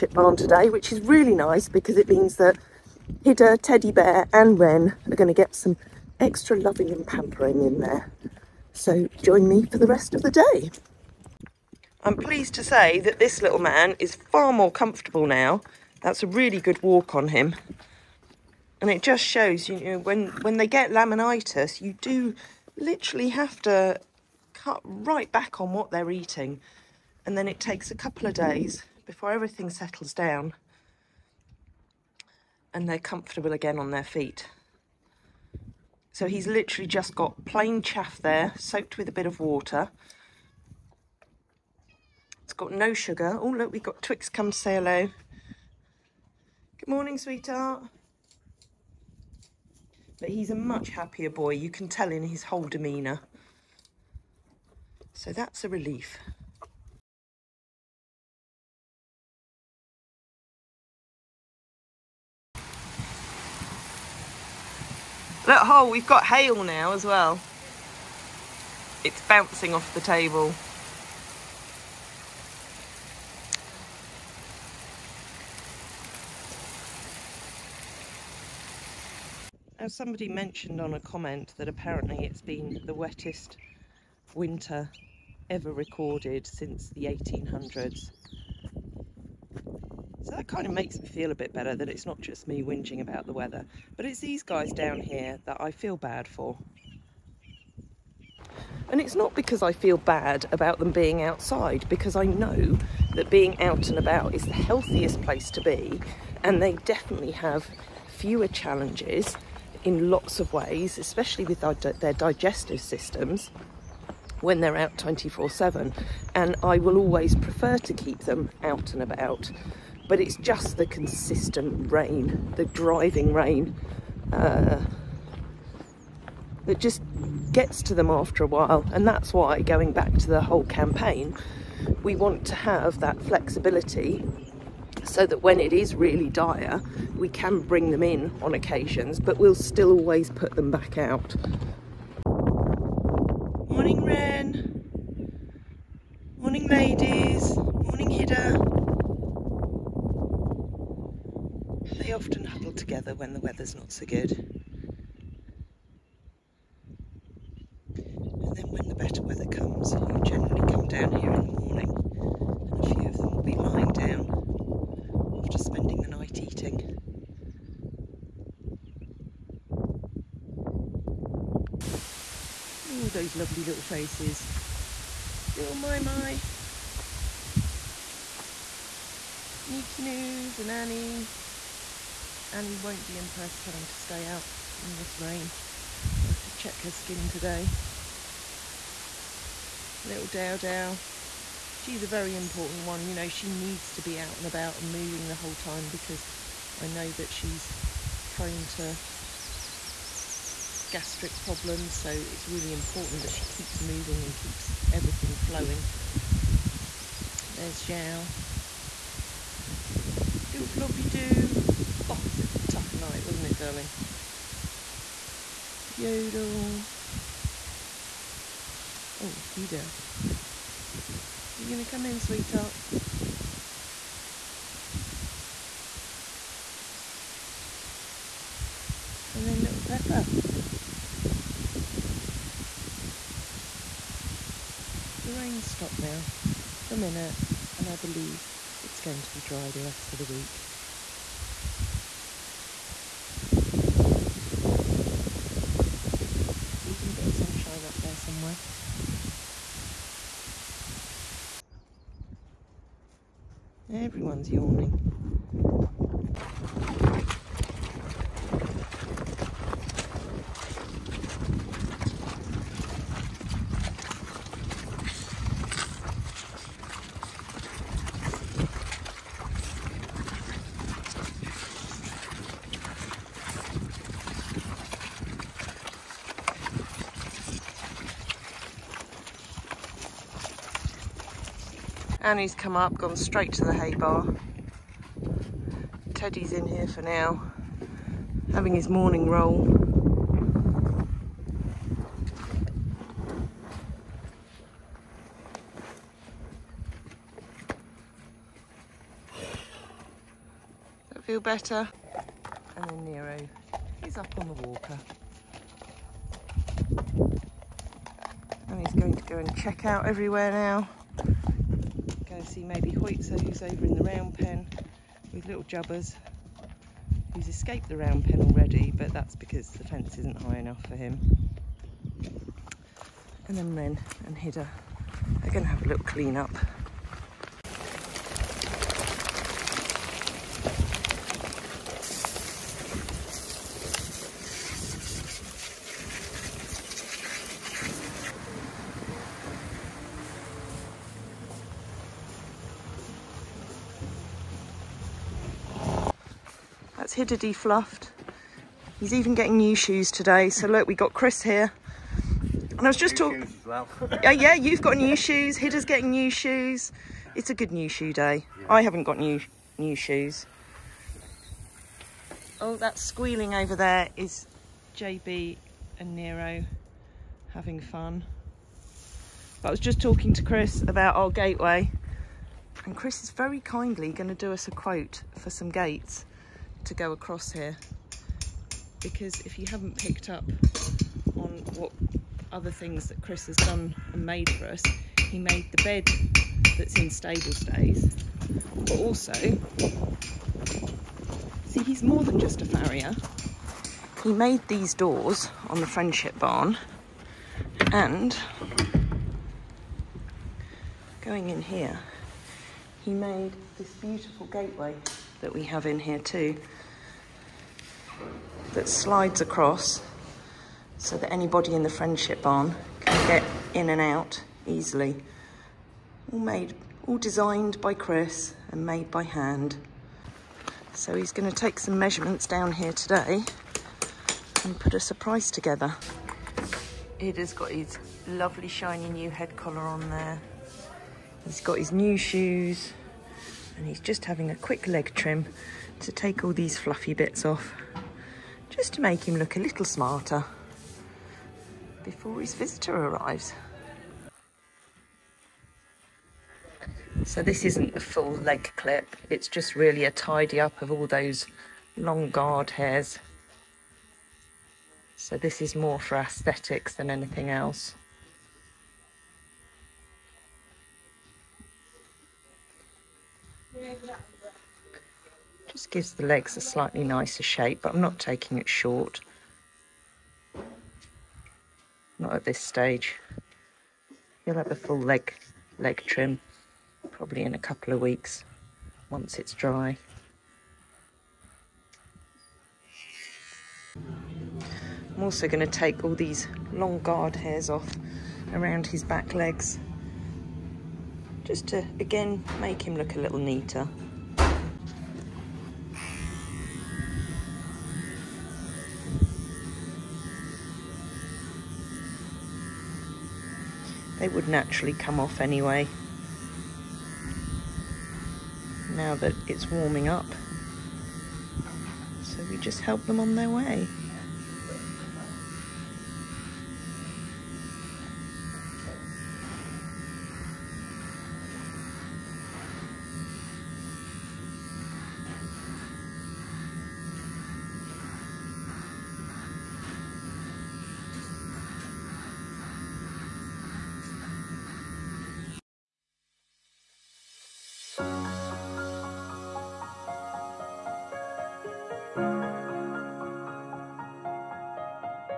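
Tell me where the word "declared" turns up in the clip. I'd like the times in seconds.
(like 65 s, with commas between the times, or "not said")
not said.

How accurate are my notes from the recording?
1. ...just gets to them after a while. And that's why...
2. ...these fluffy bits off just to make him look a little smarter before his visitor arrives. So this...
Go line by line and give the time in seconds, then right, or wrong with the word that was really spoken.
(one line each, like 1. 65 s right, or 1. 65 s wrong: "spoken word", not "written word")
1. 126 s right
2. 436 s right.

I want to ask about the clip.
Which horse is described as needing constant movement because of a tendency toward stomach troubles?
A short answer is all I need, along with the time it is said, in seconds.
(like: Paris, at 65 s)
Dow Dow, at 190 s.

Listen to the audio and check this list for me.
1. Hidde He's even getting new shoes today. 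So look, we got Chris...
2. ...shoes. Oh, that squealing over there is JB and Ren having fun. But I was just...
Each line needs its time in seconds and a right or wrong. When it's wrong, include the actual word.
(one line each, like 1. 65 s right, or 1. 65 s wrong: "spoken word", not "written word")
1. 347 s right
2. 359 s wrong: "Nero", not "Ren".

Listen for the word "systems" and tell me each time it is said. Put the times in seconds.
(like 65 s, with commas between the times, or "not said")
112 s.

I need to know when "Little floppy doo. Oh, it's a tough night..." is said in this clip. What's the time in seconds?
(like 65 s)
210 s.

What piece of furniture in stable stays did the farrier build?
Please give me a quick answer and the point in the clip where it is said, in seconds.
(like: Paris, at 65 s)
The bed, at 385 s.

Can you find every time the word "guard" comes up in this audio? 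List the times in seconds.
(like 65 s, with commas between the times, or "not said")
452 s, 487 s.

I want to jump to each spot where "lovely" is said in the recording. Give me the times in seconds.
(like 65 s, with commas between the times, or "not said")
173 s, 428 s.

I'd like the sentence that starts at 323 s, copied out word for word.
And then Ren and Hidde are going to have a little clean up.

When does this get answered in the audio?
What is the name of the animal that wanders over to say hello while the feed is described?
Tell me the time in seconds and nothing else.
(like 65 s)
44 s.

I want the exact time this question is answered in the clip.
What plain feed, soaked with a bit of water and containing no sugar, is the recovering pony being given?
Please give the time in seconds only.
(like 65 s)
37 s.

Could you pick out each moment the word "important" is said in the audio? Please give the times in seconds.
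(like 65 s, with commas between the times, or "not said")
192 s, 202 s.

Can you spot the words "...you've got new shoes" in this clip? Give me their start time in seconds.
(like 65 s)
354 s.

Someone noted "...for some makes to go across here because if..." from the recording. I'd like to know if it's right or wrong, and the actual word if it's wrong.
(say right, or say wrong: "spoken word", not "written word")
wrong: "gates", not "makes".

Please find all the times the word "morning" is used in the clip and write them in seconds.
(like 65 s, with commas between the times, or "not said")
46 s, 161 s, 288 s.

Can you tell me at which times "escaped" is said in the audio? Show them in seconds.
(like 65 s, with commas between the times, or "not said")
317 s.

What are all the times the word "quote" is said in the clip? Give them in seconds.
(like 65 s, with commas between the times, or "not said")
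374 s.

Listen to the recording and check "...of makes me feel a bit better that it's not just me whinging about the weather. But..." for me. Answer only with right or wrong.
right.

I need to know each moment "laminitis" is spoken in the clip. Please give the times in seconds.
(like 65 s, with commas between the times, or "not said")
20 s.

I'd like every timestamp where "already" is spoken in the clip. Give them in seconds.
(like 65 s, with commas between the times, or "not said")
318 s.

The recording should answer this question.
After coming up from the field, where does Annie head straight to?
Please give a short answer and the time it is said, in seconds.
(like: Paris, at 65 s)
The hay bar, at 283 s.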